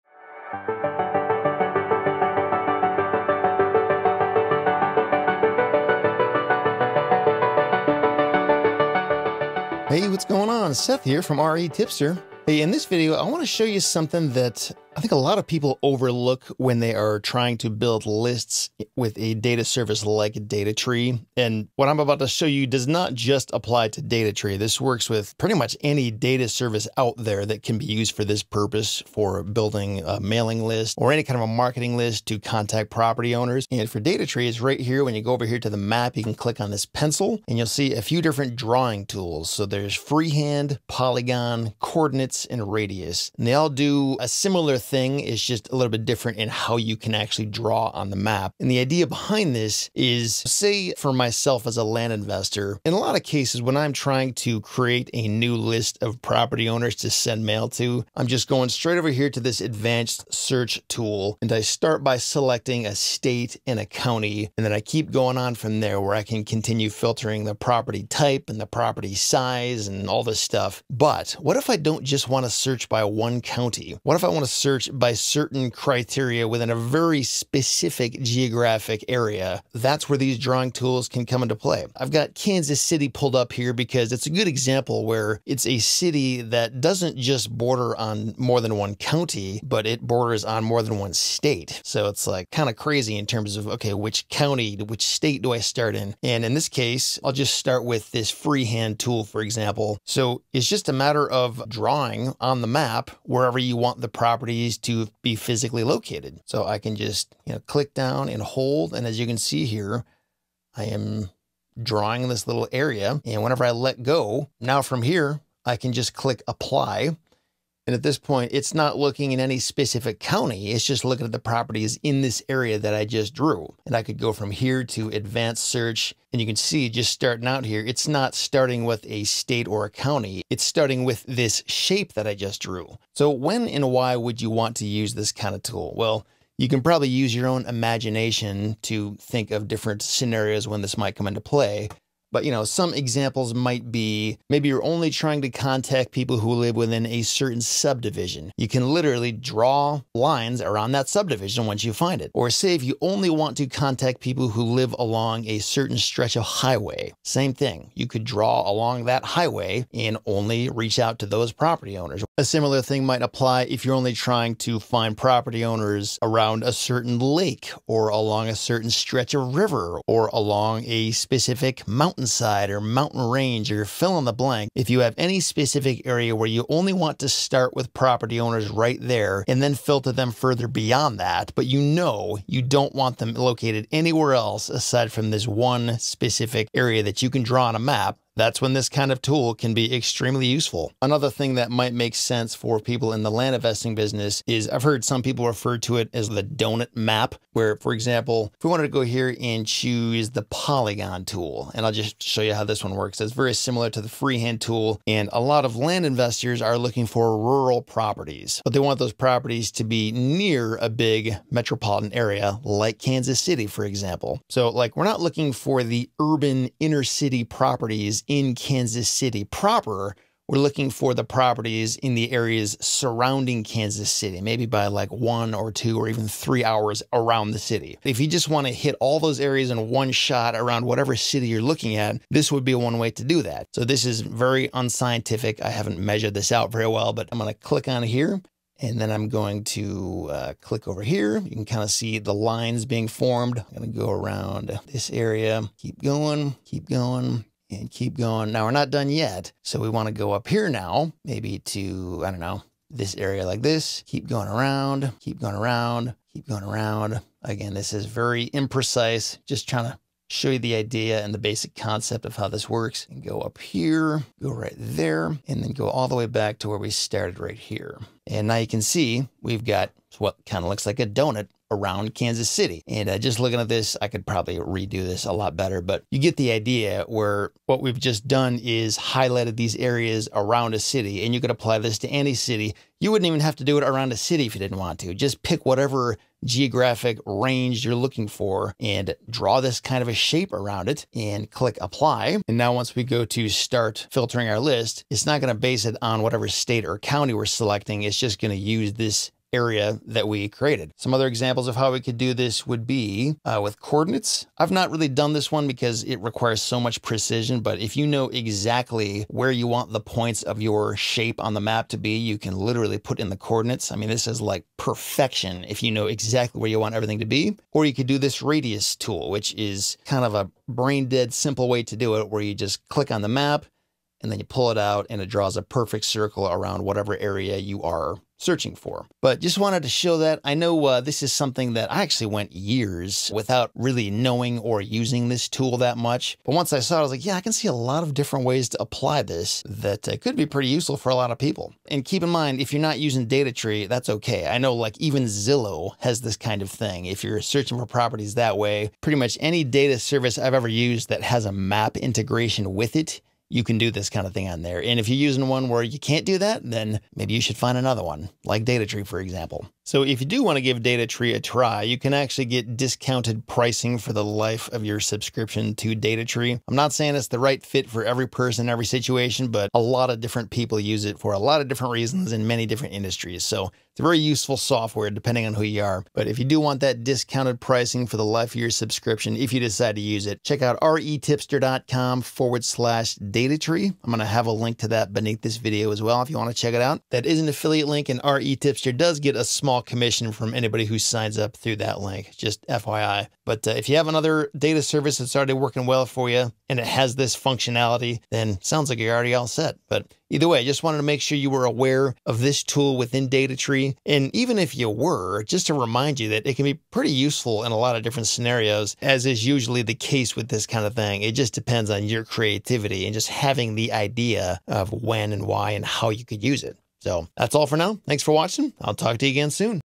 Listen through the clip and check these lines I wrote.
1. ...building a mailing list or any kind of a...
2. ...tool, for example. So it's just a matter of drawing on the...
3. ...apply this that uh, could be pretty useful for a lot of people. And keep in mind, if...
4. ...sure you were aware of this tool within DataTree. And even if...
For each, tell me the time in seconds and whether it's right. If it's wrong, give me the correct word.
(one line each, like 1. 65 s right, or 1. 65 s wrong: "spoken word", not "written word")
1. 29 s right
2. 98 s right
3. 338 s right
4. 401 s right.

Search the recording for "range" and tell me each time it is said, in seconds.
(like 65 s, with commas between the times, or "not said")
173 s, 287 s.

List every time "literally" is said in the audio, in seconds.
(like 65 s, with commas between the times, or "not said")
148 s, 312 s.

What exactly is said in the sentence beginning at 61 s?
And I start by selecting a state and a county.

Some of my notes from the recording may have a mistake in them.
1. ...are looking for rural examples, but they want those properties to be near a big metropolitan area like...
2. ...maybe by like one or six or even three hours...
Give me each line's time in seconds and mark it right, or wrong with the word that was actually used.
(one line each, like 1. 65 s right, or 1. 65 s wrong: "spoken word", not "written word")
1. 206 s wrong: "properties", not "examples"
2. 224 s wrong: "two", not "six".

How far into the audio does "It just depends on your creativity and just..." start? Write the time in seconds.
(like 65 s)
411 s.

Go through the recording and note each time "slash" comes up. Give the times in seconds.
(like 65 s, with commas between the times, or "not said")
382 s.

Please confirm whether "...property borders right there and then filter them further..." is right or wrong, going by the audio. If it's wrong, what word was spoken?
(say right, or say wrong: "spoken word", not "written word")
wrong: "owners", not "borders".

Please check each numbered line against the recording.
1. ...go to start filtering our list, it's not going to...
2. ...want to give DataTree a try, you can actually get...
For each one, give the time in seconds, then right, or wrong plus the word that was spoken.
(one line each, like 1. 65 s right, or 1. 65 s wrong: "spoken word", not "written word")
1. 293 s right
2. 360 s right.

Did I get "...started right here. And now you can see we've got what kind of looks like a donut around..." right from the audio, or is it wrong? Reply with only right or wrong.
right.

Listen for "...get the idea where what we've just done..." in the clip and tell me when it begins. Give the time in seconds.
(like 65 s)
276 s.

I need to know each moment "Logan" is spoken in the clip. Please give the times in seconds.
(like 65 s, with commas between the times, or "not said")
not said.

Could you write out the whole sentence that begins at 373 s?
So it's a very useful software depending on who you are.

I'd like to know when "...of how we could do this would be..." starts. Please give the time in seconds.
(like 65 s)
301 s.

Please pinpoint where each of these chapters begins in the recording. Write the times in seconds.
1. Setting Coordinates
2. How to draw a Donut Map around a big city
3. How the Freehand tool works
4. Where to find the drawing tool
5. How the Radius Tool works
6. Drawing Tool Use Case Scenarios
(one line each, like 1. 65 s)
1. 300 s
2. 191 s
3. 98 s
4. 34 s
5. 317 s
6. 133 s.